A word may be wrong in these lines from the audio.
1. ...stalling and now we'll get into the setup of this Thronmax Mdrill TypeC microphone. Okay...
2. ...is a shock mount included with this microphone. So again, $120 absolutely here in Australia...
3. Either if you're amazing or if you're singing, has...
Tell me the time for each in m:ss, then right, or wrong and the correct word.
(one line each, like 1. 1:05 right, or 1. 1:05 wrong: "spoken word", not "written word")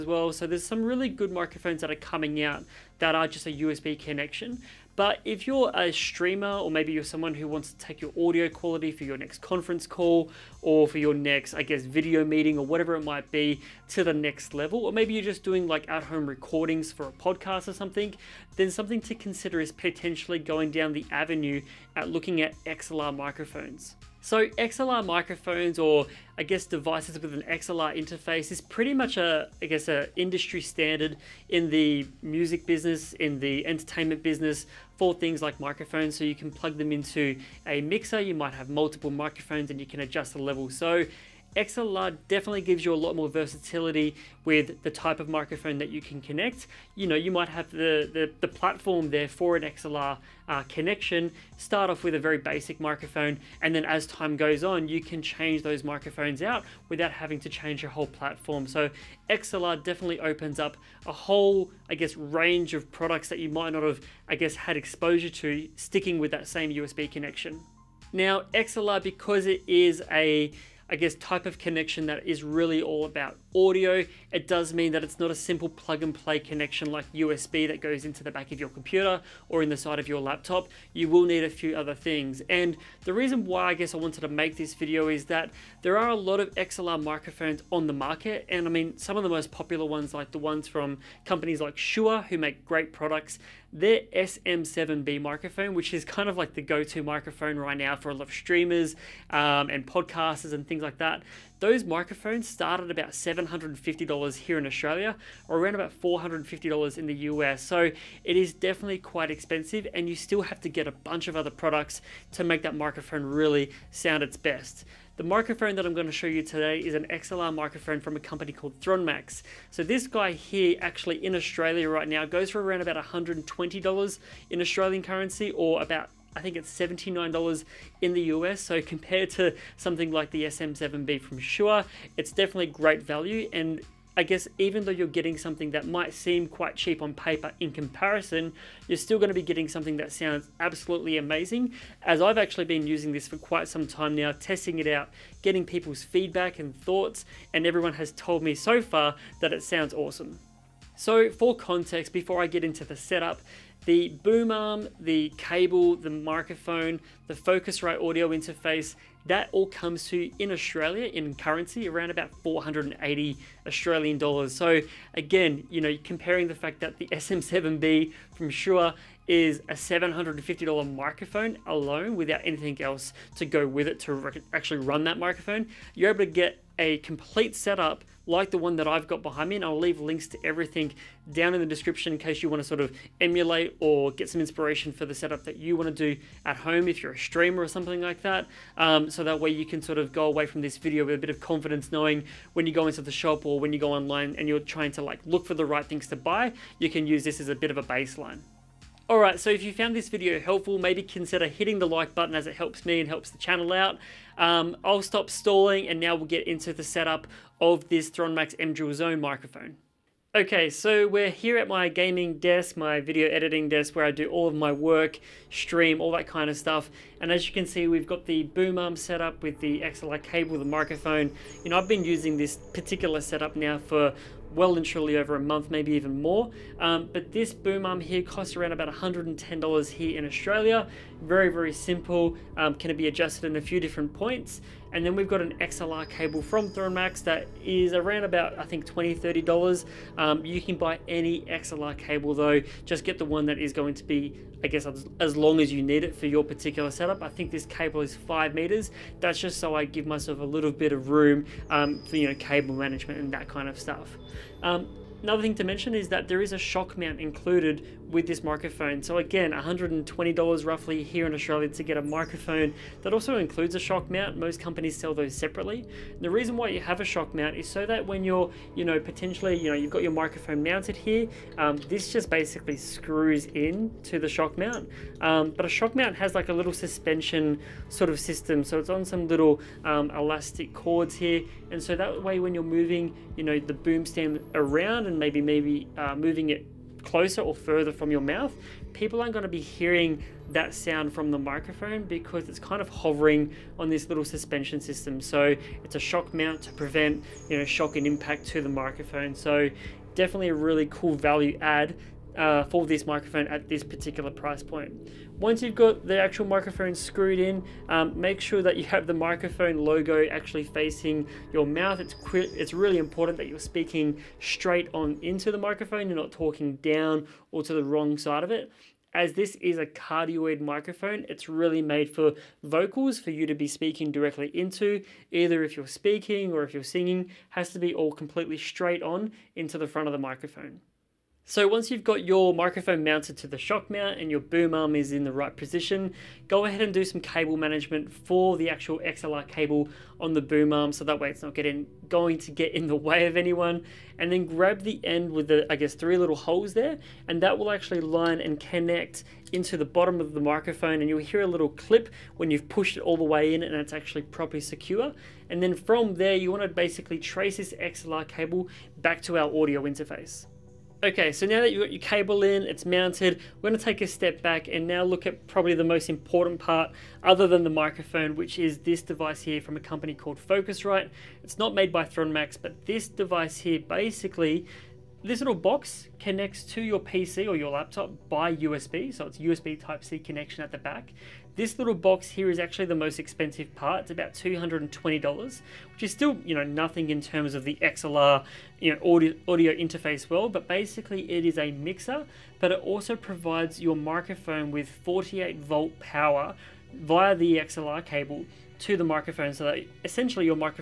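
1. 3:25 wrong: "Zone", not "TypeC"
2. 4:16 wrong: "roughly", not "absolutely"
3. 5:25 wrong: "speaking", not "amazing".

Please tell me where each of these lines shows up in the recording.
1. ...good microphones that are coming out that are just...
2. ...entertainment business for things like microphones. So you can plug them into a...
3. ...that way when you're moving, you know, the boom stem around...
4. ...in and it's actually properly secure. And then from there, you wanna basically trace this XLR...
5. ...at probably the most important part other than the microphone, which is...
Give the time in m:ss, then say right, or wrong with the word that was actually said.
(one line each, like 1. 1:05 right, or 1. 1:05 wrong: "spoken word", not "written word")
1. 0:01 right
2. 0:33 right
3. 4:41 right
4. 5:53 right
5. 6:05 right.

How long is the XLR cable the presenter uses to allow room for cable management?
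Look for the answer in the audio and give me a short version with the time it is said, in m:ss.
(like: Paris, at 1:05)
5 meters, at 4:08.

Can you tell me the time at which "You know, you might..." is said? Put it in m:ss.
0:46.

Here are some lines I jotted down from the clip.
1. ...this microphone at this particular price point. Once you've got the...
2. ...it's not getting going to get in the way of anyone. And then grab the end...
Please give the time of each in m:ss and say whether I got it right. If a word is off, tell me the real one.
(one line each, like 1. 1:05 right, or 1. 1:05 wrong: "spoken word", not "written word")
1. 5:02 right
2. 5:41 right.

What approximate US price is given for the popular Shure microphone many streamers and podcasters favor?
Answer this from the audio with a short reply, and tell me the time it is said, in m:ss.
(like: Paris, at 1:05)
$450, at 1:46.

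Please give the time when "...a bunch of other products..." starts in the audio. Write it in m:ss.
1:50.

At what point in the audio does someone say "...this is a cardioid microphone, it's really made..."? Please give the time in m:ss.
5:19.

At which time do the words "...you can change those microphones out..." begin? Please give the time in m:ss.
0:54.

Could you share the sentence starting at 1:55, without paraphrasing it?
The microphone that I'm going to show you today is an XLR microphone from a company called Thronmax.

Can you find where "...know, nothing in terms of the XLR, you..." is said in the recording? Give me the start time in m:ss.
6:26.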